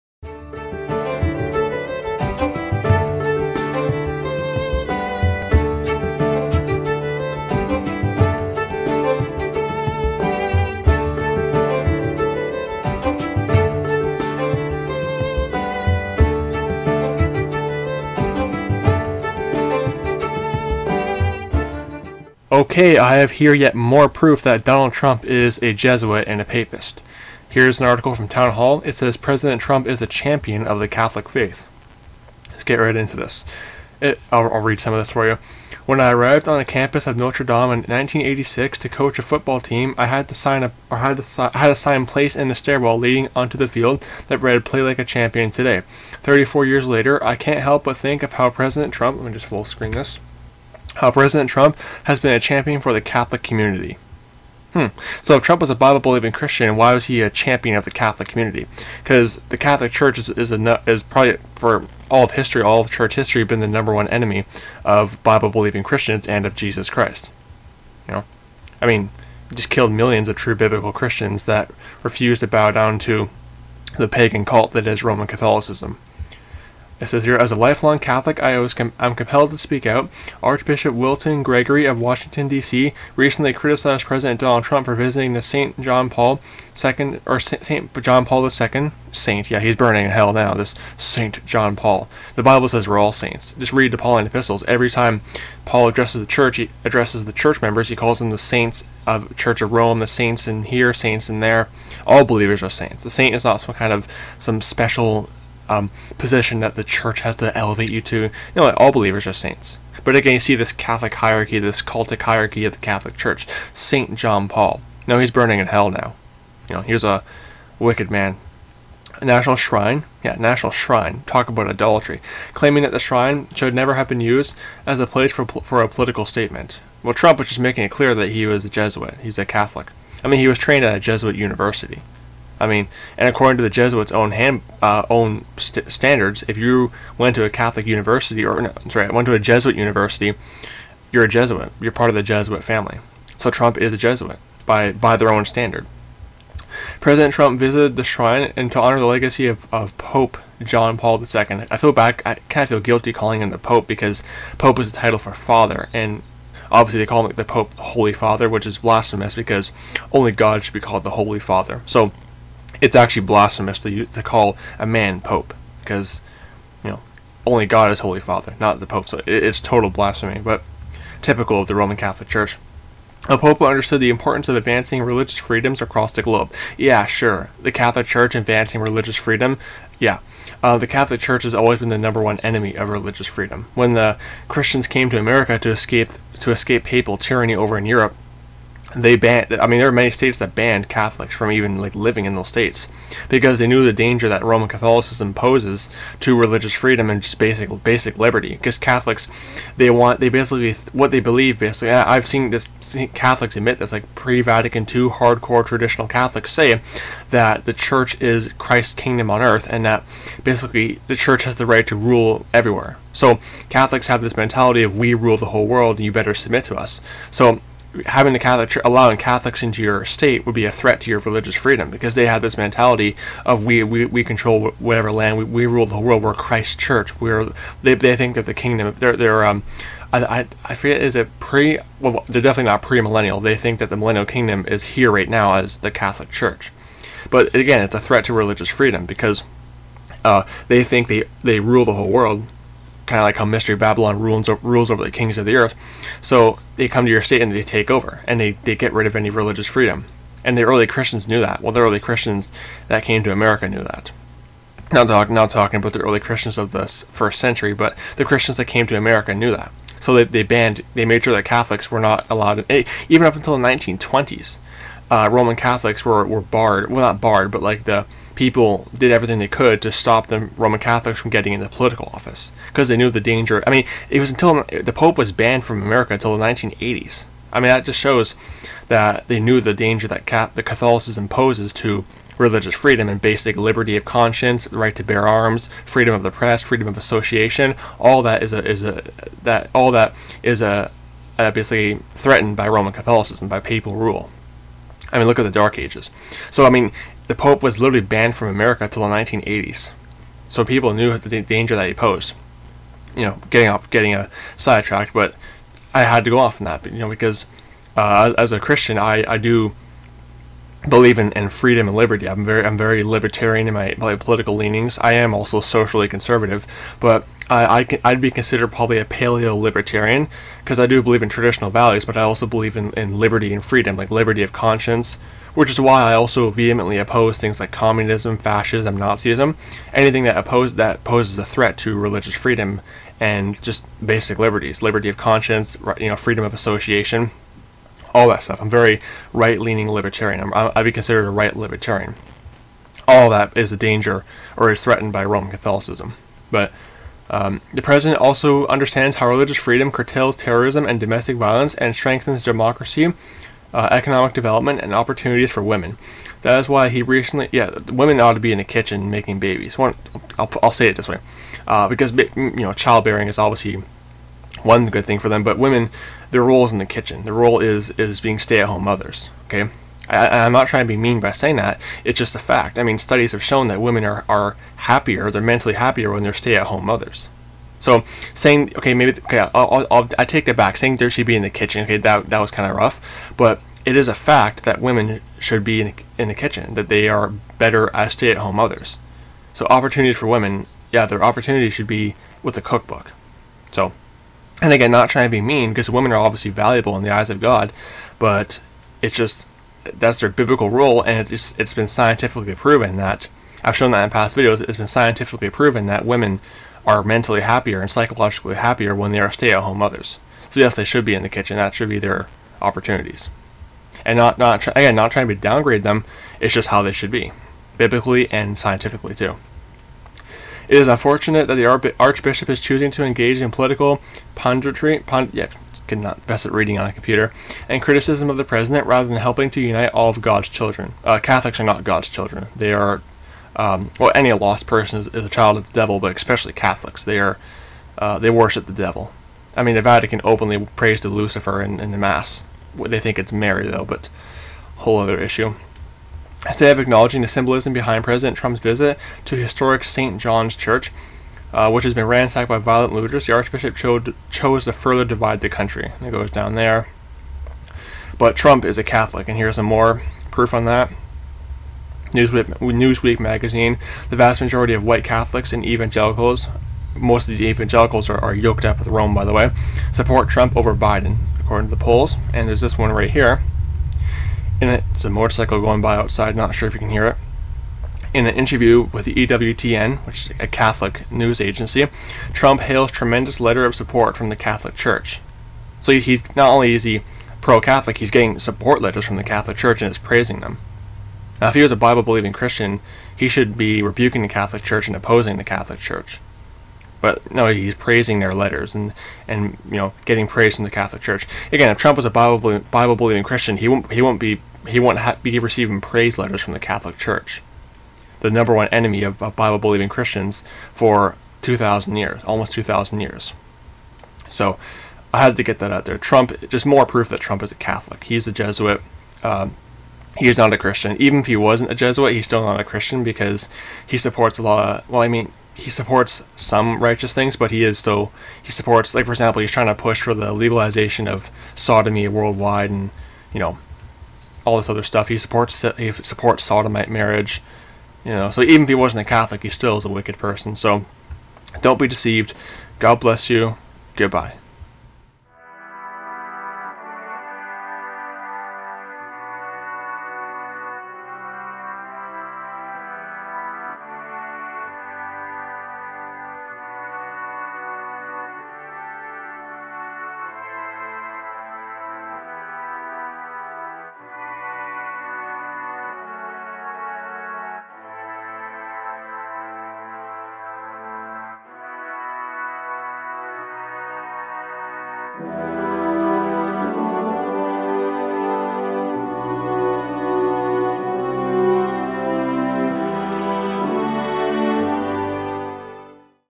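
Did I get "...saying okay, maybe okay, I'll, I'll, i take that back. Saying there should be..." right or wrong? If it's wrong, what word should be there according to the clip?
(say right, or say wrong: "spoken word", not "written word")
right.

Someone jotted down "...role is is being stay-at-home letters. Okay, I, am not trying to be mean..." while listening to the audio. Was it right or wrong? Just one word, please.
wrong.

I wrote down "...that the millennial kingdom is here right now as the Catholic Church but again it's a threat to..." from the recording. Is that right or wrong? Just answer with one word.
right.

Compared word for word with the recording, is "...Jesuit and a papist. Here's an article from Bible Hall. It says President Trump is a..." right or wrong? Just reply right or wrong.
wrong.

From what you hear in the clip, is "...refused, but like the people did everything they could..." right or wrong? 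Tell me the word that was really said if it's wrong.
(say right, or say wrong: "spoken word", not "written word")
wrong: "barred", not "refused".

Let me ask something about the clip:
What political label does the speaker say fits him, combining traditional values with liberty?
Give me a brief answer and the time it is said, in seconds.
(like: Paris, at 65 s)
paleo libertarian, at 319 s.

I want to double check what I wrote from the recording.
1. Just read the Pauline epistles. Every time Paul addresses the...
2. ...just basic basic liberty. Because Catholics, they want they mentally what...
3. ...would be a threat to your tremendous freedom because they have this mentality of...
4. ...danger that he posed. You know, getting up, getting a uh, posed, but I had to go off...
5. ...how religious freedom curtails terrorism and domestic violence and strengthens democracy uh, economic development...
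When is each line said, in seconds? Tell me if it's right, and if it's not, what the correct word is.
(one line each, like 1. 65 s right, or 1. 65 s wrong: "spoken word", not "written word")
1. 93 s right
2. 197 s wrong: "basically", not "mentally"
3. 220 s wrong: "religious", not "tremendous"
4. 301 s wrong: "sidetracked", not "posed"
5. 349 s right.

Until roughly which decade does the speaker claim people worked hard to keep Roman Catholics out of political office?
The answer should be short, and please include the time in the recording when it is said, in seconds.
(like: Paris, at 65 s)
1920s, at 263 s.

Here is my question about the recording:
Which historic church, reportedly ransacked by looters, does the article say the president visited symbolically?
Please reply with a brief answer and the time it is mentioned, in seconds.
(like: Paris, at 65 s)
St. John's Church, at 449 s.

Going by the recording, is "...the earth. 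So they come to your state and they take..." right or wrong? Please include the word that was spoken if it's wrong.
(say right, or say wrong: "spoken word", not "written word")
right.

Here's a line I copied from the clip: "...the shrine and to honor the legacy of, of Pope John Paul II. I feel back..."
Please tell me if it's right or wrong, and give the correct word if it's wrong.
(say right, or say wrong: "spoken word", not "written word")
right.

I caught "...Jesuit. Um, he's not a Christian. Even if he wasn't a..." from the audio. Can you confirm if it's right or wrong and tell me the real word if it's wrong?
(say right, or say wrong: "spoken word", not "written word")
right.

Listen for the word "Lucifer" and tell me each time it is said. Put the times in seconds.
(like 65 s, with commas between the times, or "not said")
441 s.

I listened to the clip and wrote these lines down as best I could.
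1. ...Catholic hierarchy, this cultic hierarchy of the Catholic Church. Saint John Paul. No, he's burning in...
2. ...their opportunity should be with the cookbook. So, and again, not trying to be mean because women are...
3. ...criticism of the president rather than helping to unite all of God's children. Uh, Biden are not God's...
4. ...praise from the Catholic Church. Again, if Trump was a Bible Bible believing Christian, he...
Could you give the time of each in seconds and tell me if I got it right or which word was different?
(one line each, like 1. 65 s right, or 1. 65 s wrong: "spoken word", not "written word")
1. 110 s right
2. 391 s right
3. 427 s wrong: "Catholics", not "Biden"
4. 500 s right.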